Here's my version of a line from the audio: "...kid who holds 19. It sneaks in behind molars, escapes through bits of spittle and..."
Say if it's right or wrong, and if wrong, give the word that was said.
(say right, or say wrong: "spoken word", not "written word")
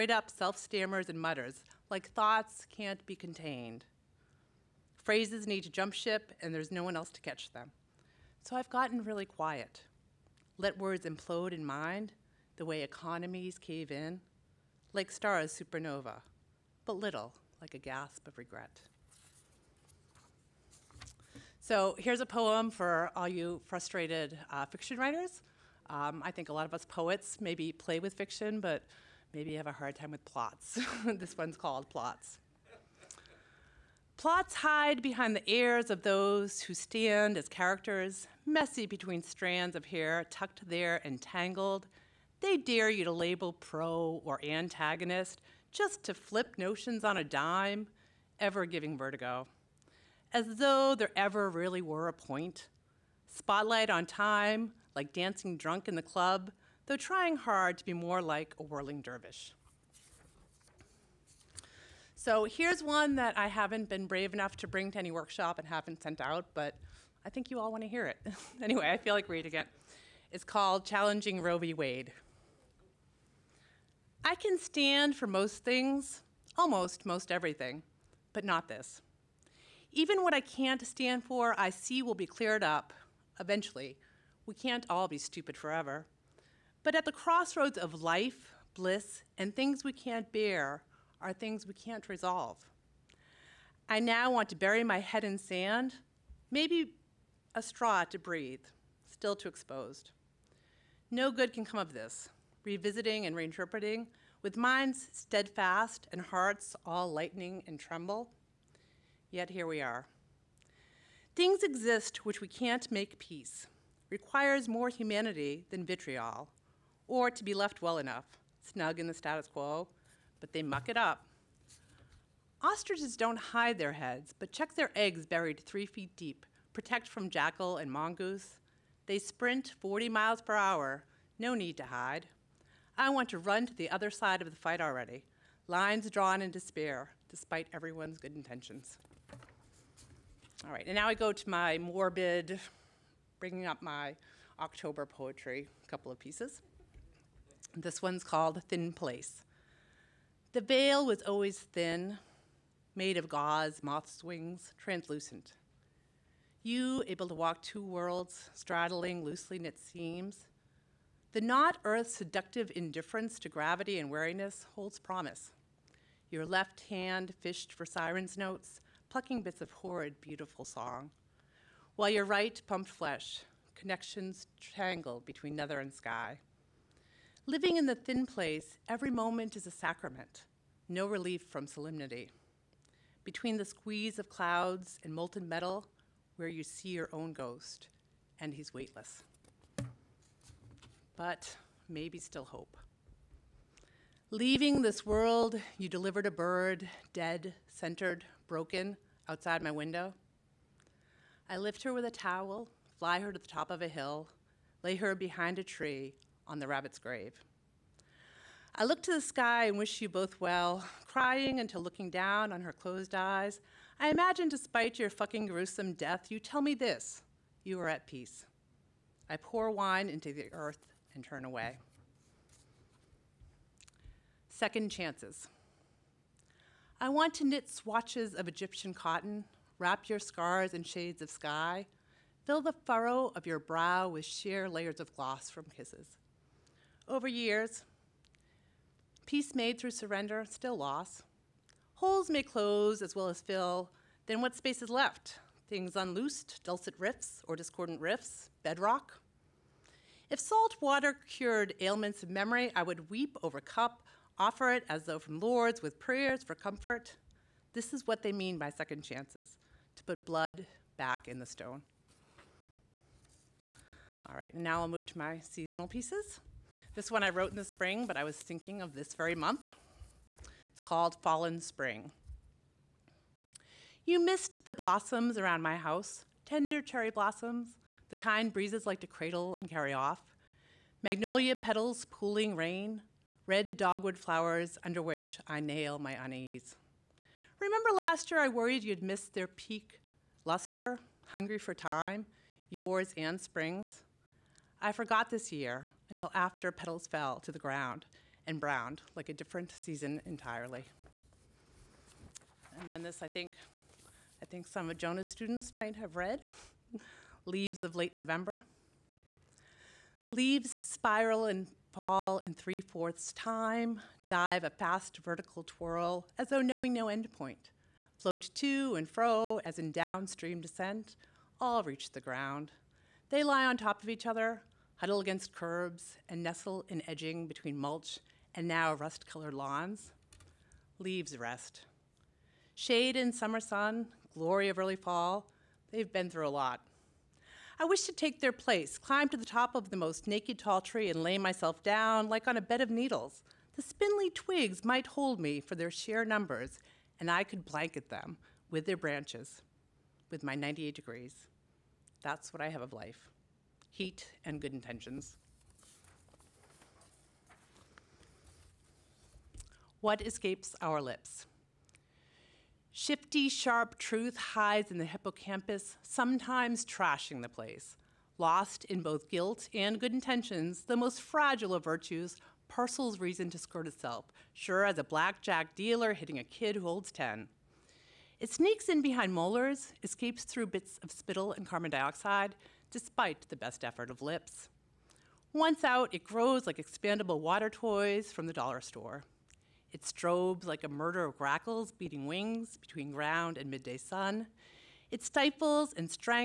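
wrong: "10", not "19".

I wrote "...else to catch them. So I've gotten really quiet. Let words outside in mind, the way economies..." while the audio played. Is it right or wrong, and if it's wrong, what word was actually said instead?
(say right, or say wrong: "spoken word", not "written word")
wrong: "implode", not "outside".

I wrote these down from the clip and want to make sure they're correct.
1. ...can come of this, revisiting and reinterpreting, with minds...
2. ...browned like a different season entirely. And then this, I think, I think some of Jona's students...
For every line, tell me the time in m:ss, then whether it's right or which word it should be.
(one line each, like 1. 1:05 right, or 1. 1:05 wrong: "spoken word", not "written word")
1. 1:41 right
2. 4:58 right.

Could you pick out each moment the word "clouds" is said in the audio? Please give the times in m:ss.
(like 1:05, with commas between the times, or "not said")
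3:04.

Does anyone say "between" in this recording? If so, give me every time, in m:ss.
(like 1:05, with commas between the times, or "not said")
0:38, 2:55, 3:03, 5:27, 6:32.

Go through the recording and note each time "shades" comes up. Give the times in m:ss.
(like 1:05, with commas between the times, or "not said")
3:50, 5:32.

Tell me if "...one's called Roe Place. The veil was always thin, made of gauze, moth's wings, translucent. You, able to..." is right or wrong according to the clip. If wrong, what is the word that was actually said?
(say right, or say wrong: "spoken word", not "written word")
wrong: "Thin", not "Roe".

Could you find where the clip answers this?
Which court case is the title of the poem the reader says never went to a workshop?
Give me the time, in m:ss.
1:11.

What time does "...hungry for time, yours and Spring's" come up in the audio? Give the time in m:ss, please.
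4:51.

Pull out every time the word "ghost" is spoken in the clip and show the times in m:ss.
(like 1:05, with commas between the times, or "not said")
3:07.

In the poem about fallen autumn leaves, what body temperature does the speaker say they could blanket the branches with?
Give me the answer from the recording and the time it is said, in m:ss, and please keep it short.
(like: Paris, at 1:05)
98 degrees, at 5:50.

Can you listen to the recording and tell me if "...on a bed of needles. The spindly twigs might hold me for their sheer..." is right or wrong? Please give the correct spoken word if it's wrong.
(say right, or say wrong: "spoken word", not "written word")
right.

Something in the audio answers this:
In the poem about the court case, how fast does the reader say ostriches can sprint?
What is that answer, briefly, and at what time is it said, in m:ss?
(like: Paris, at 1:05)
40 miles per hour, at 2:09.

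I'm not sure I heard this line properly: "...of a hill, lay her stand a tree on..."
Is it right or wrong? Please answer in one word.
wrong.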